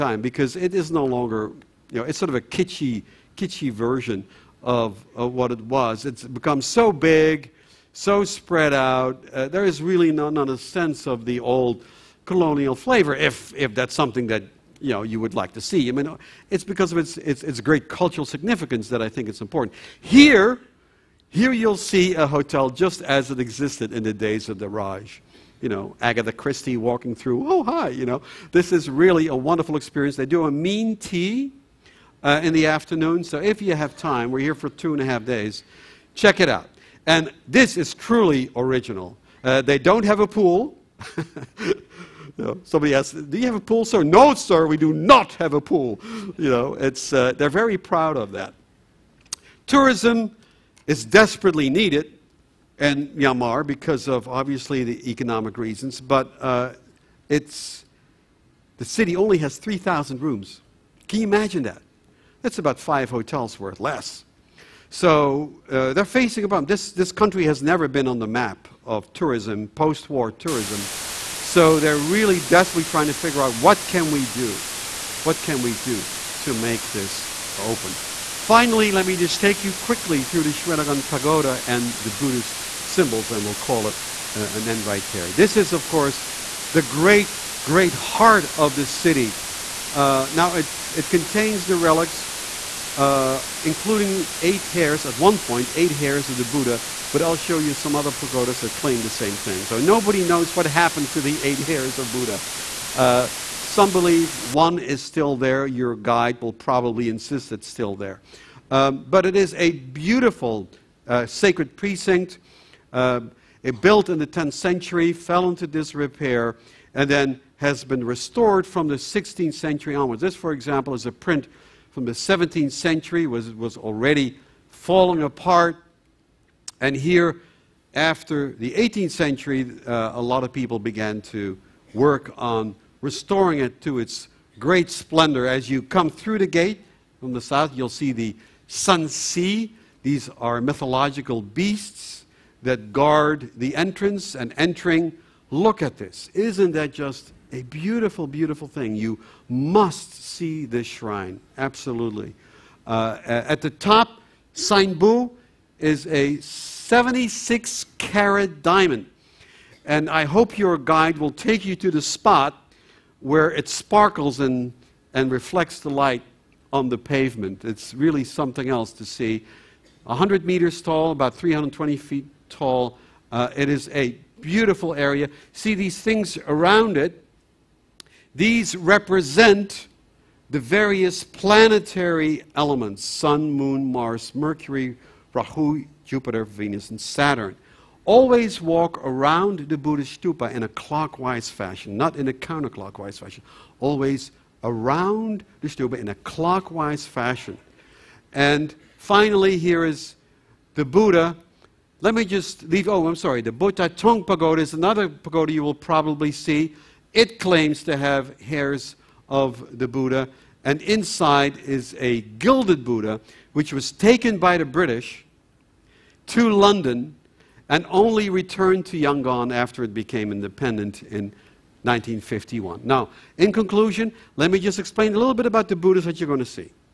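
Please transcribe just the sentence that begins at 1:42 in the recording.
Uh, some believe one is still there.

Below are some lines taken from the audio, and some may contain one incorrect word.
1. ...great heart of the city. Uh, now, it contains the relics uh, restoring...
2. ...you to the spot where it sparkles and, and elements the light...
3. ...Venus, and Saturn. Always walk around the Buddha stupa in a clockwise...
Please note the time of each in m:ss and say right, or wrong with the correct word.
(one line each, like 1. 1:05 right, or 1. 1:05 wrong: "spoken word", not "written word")
1. 1:27 wrong: "including", not "restoring"
2. 2:41 wrong: "reflects", not "elements"
3. 3:06 right.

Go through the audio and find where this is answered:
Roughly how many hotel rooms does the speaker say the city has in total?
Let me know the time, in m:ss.
0:59.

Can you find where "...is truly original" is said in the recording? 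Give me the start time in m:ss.
0:37.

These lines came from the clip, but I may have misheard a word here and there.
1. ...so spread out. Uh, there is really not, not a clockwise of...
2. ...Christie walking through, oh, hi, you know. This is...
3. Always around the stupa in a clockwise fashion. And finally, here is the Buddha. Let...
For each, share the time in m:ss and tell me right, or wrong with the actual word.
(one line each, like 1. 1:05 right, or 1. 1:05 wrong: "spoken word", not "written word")
1. 0:07 wrong: "sense", not "clockwise"
2. 0:26 right
3. 3:13 right.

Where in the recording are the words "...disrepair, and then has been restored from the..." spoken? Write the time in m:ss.
1:55.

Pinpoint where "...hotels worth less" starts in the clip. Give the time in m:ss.
1:03.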